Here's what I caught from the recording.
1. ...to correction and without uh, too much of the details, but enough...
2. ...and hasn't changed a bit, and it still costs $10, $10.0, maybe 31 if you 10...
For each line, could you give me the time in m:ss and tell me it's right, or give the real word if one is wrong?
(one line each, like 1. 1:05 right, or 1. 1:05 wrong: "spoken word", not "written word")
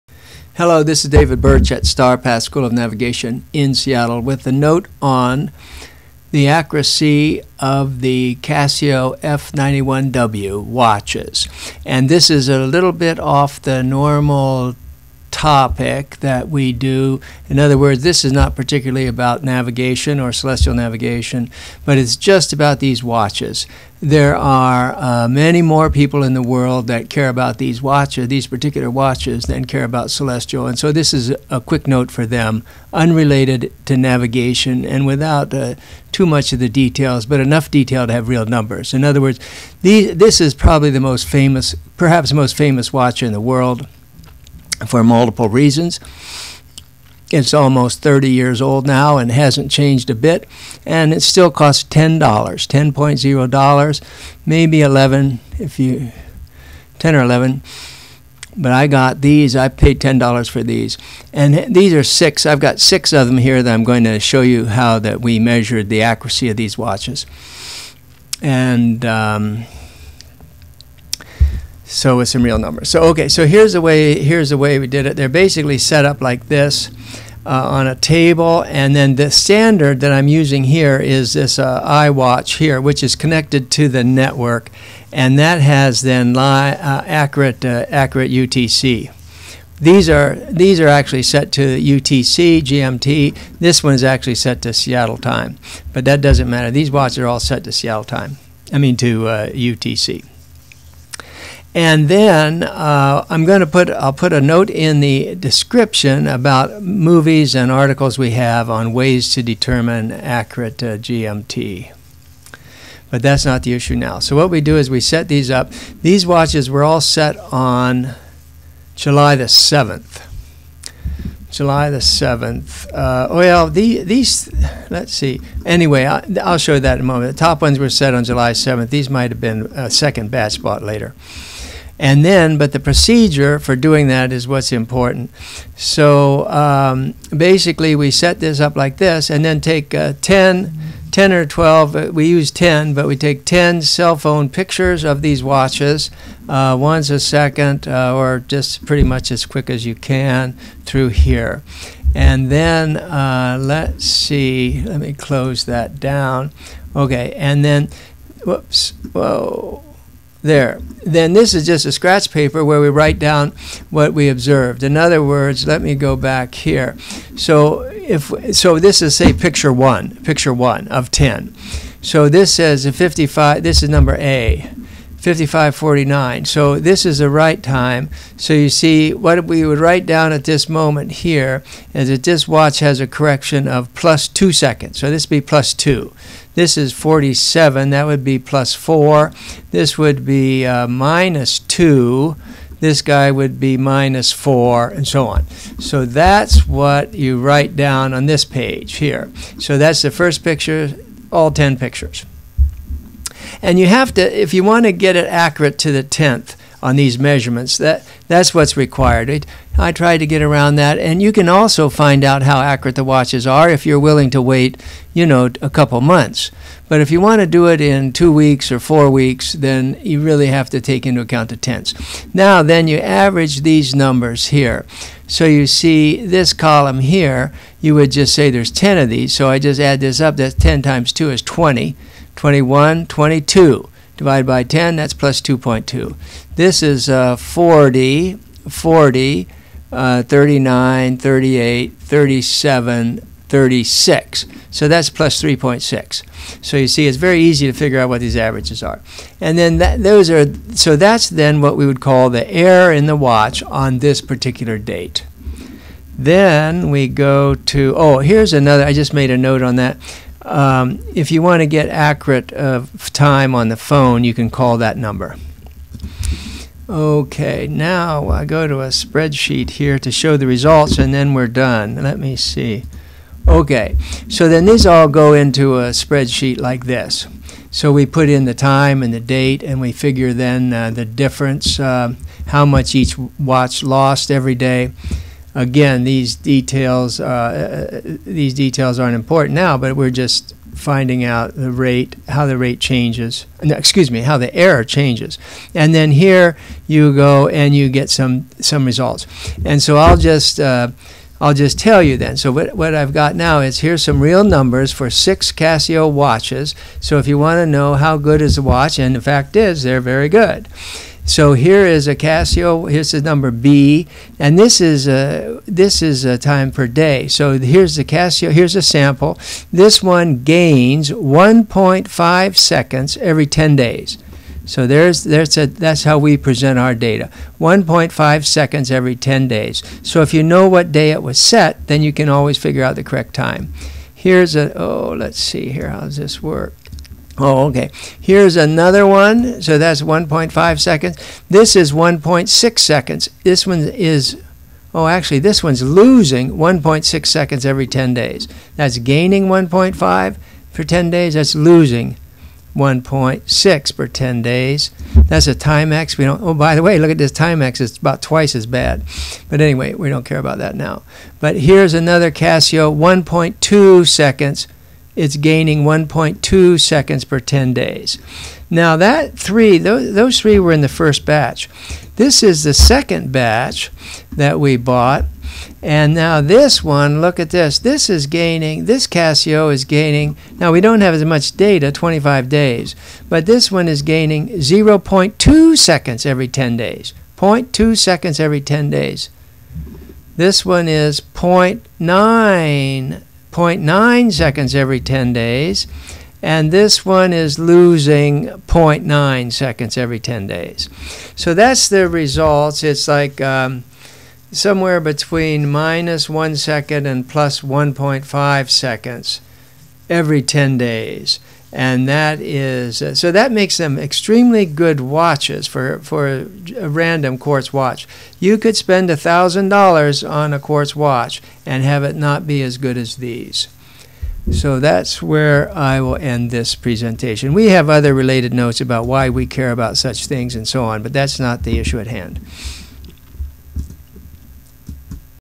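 1. 0:33 wrong: "navigation", not "correction"
2. 0:49 wrong: "11", not "31".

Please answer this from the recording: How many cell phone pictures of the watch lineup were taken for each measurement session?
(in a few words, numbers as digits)
10.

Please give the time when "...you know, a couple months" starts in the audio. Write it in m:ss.
3:35.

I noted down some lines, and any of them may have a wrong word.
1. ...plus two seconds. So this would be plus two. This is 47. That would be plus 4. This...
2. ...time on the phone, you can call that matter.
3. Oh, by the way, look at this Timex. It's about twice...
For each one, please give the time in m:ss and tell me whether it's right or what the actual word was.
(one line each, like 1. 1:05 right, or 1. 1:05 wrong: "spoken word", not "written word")
1. 3:03 right
2. 4:23 wrong: "number", not "matter"
3. 5:56 right.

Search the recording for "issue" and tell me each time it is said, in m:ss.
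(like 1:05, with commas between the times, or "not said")
1:53, 7:11.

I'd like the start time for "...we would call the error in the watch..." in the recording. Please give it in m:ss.
4:11.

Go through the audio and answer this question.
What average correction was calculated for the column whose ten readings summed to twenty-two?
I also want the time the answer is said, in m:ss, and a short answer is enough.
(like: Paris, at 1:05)
plus 2.2, at 3:55.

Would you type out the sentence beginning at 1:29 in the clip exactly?
These are these are actually set to UTC, GMT.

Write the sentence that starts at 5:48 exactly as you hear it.
That's gaining 1.5 for 10 days.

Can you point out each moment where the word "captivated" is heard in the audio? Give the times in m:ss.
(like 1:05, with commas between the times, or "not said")
not said.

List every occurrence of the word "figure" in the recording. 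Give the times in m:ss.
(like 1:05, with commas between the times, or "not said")
4:07, 4:39, 5:32.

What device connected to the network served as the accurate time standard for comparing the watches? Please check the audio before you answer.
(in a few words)
iWatch.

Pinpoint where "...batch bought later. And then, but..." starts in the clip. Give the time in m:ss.
2:10.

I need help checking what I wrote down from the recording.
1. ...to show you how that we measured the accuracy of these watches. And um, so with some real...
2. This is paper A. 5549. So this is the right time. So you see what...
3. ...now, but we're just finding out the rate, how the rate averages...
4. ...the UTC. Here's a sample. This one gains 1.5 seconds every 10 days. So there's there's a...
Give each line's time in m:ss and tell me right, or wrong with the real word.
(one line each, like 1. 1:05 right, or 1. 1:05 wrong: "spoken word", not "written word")
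1. 1:04 right
2. 2:53 wrong: "number", not "paper"
3. 4:49 wrong: "changes", not "averages"
4. 5:17 wrong: "Casio", not "UTC".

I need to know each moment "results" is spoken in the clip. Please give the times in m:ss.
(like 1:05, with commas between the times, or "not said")
4:30, 4:58, 6:42.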